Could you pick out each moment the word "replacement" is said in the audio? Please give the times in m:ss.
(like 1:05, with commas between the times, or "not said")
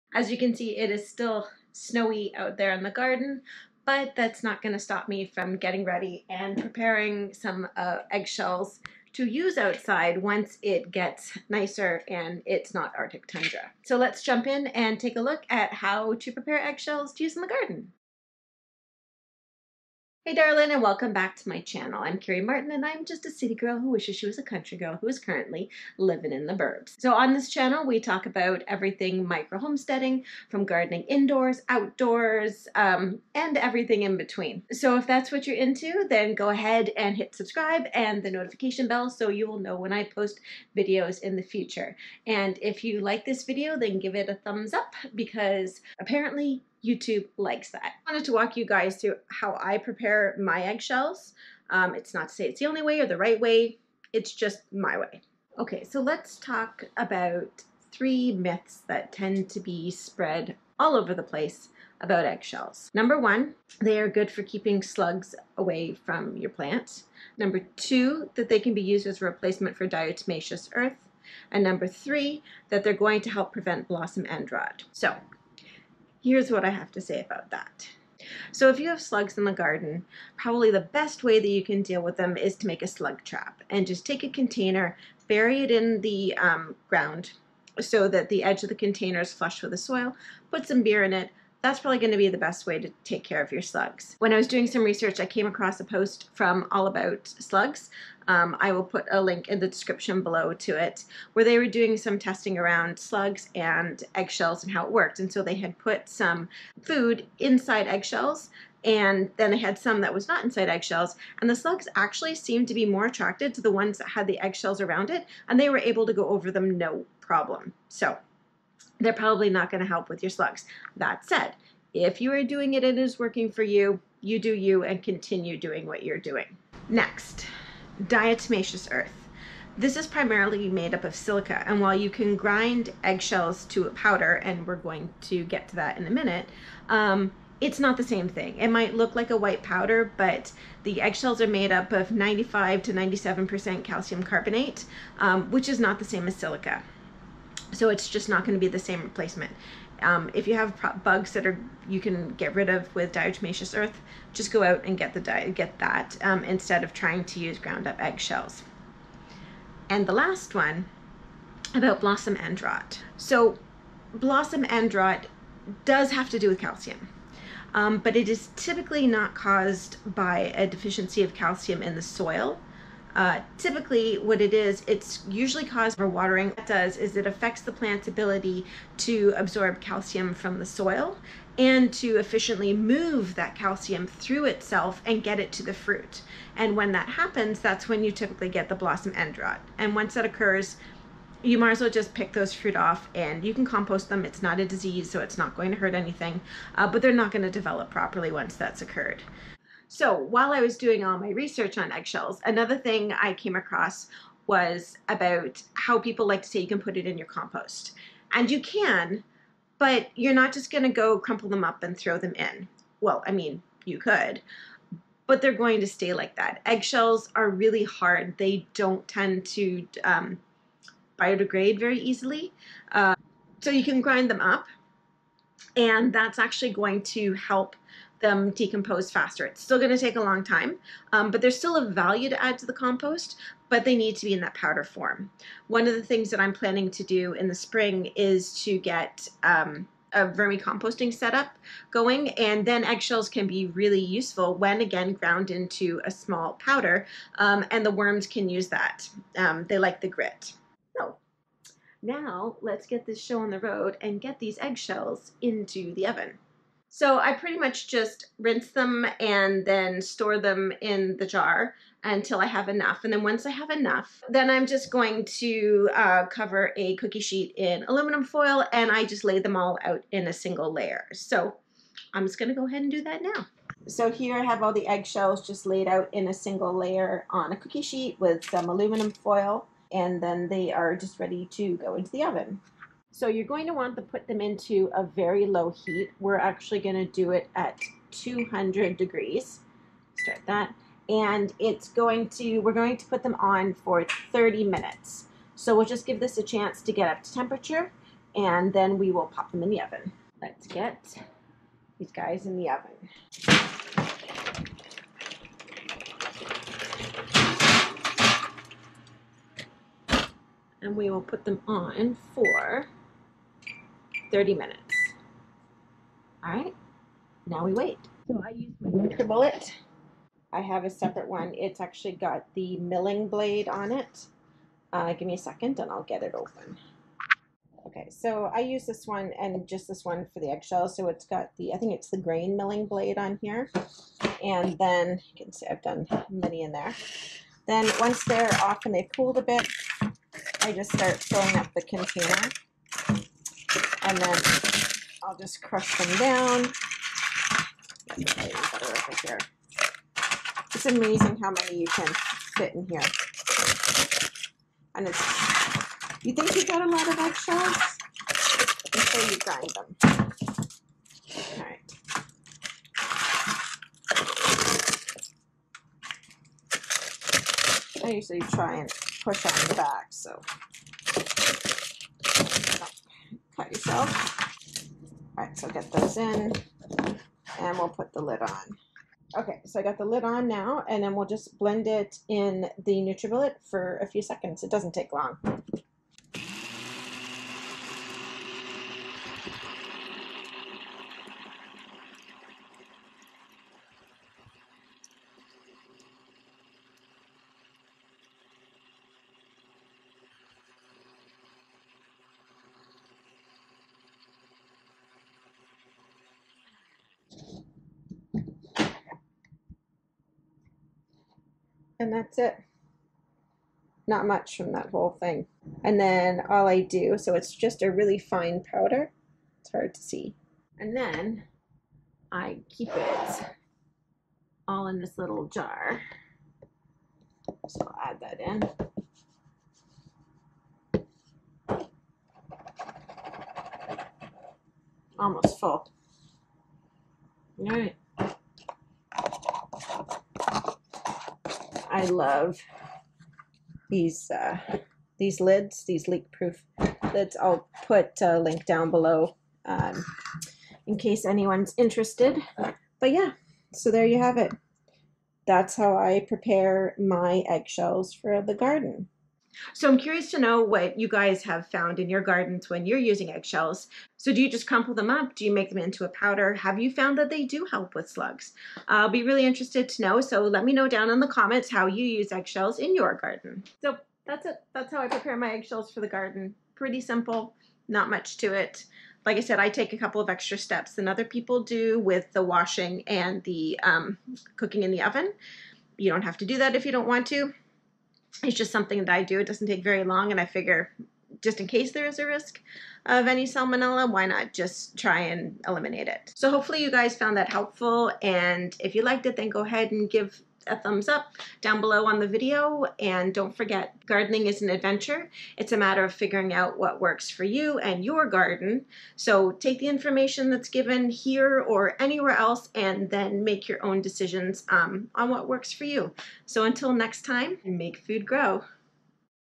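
1:09, 2:29.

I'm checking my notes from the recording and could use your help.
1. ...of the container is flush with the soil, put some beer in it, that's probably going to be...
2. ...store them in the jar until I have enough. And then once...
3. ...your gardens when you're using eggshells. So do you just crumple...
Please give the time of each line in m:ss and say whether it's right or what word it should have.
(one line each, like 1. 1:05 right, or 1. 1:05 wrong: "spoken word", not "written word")
1. 1:28 right
2. 4:20 right
3. 7:42 right.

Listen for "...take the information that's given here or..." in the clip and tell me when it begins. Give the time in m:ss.
8:29.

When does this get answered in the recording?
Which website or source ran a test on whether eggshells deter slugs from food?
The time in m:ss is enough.
1:36.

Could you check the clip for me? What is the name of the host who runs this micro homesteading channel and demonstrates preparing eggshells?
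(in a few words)
Carrie Martin.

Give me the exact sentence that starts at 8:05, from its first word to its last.
You don't have to do that if you don't want to it's just something that I do.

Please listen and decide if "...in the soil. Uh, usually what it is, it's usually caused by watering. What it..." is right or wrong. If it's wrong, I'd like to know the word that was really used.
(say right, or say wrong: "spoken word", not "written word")
wrong: "typically", not "usually".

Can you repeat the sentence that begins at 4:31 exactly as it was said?
So I'm just gonna go ahead and do that now.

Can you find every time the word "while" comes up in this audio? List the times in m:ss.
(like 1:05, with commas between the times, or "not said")
2:11, 3:20.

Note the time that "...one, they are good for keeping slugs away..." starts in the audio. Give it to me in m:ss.
1:03.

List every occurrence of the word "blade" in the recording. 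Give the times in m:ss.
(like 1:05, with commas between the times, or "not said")
5:23, 5:32.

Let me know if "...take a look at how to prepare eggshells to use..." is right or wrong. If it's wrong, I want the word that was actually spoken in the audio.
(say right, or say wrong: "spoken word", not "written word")
right.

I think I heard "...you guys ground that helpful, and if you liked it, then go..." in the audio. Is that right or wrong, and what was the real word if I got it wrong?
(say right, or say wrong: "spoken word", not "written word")
wrong: "found", not "ground".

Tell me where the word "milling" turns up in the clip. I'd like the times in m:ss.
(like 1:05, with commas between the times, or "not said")
5:22, 5:32.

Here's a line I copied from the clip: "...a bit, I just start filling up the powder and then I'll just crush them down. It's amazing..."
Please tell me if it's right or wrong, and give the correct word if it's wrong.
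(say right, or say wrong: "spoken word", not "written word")
wrong: "container", not "powder".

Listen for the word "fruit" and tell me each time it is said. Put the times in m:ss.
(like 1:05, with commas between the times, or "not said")
3:05, 3:12.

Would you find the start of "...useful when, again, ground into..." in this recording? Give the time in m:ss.
4:03.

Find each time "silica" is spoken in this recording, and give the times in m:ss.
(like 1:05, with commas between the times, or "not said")
2:11, 2:26.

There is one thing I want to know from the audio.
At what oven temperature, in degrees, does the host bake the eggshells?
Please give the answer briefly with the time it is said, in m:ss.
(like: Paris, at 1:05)
200, at 4:48.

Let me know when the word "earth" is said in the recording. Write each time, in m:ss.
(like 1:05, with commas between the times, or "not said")
1:10, 2:08, 2:33.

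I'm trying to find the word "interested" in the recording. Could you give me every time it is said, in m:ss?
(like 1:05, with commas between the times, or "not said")
7:31, 7:49.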